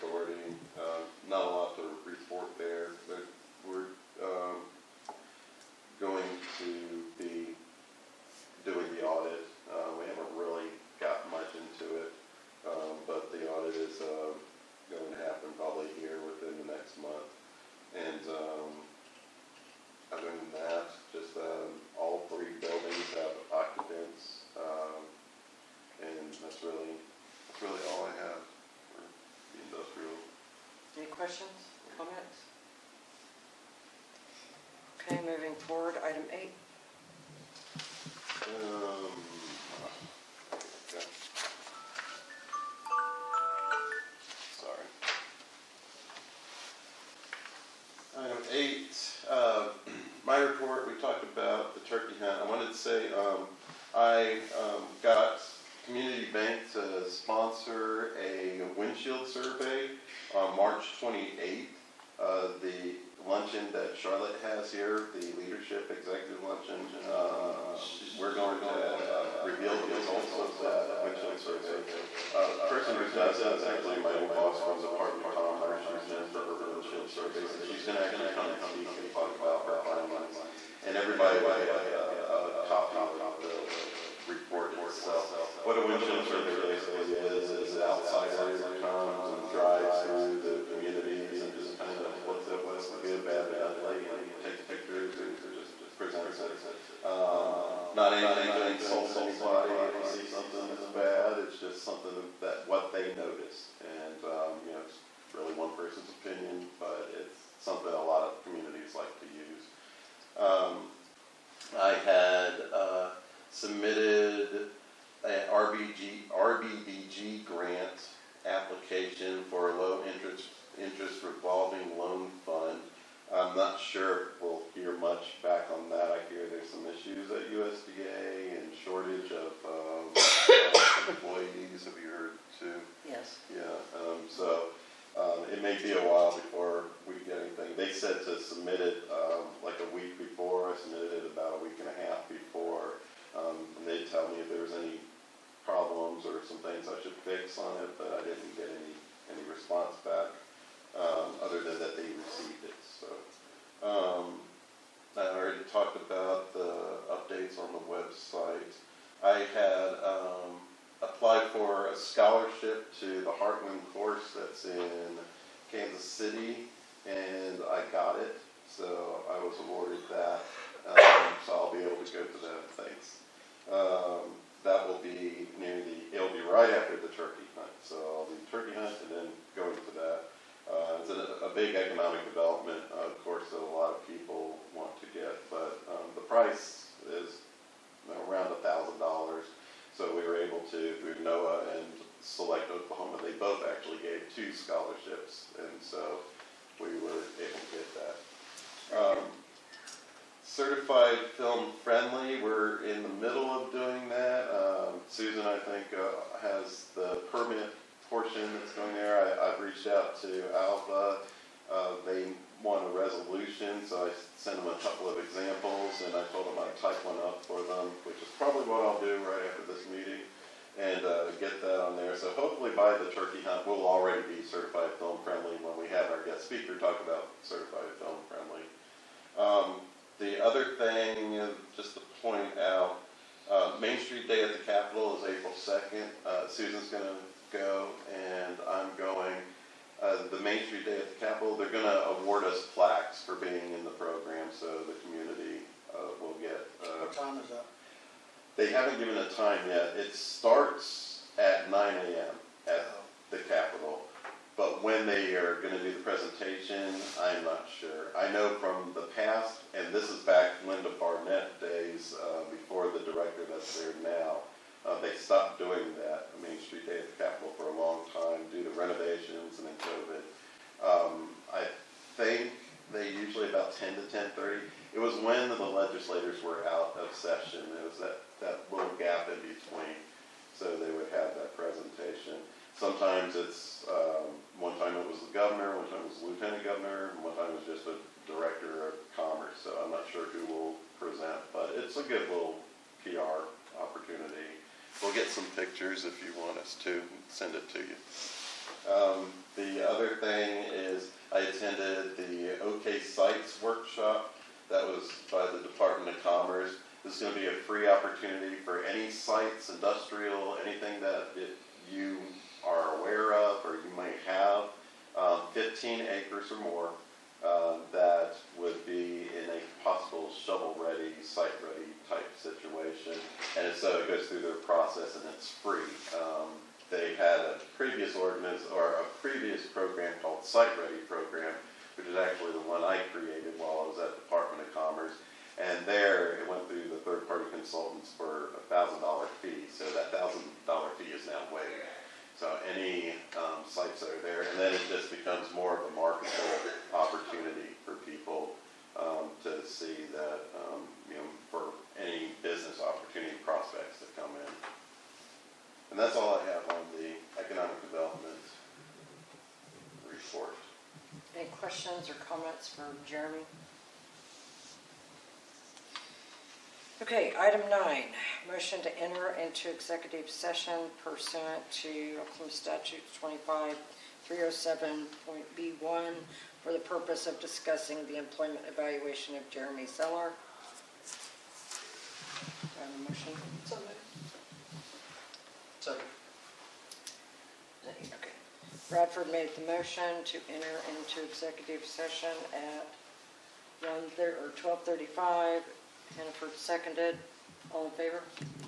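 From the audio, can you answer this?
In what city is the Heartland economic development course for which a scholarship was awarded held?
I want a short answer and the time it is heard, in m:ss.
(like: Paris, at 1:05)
Kansas City, at 2:45.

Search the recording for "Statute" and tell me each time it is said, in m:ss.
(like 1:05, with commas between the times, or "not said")
6:12.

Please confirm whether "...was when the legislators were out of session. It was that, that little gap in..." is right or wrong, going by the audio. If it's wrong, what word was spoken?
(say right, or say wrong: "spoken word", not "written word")
right.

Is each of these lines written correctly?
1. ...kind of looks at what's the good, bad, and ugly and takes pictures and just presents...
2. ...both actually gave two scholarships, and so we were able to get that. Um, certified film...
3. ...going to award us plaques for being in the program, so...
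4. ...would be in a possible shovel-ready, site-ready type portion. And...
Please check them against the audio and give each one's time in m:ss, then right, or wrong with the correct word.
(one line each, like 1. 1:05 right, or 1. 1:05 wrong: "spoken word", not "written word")
1. 1:31 right
2. 3:13 right
3. 4:01 right
4. 5:18 wrong: "situation", not "portion".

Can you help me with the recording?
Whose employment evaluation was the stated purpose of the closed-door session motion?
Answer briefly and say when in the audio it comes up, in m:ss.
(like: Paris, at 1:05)
Jeremy Zeller, at 6:19.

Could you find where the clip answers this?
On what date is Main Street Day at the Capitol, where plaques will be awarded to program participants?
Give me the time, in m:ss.
3:55.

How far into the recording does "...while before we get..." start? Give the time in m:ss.
2:16.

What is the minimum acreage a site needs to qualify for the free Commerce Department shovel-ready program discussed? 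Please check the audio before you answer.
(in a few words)
15 acres.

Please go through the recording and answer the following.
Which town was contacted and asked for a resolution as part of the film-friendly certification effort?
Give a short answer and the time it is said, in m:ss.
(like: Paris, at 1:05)
Alva, at 3:30.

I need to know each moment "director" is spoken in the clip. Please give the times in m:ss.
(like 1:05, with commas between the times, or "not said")
4:23, 4:48.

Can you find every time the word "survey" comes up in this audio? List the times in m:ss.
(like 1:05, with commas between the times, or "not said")
0:59, 1:11, 1:17, 1:26.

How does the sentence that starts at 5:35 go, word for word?
And there, it went through the third-party consultants for a thousand dollar fee.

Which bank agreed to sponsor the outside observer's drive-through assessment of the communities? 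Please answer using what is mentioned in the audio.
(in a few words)
Community Bank.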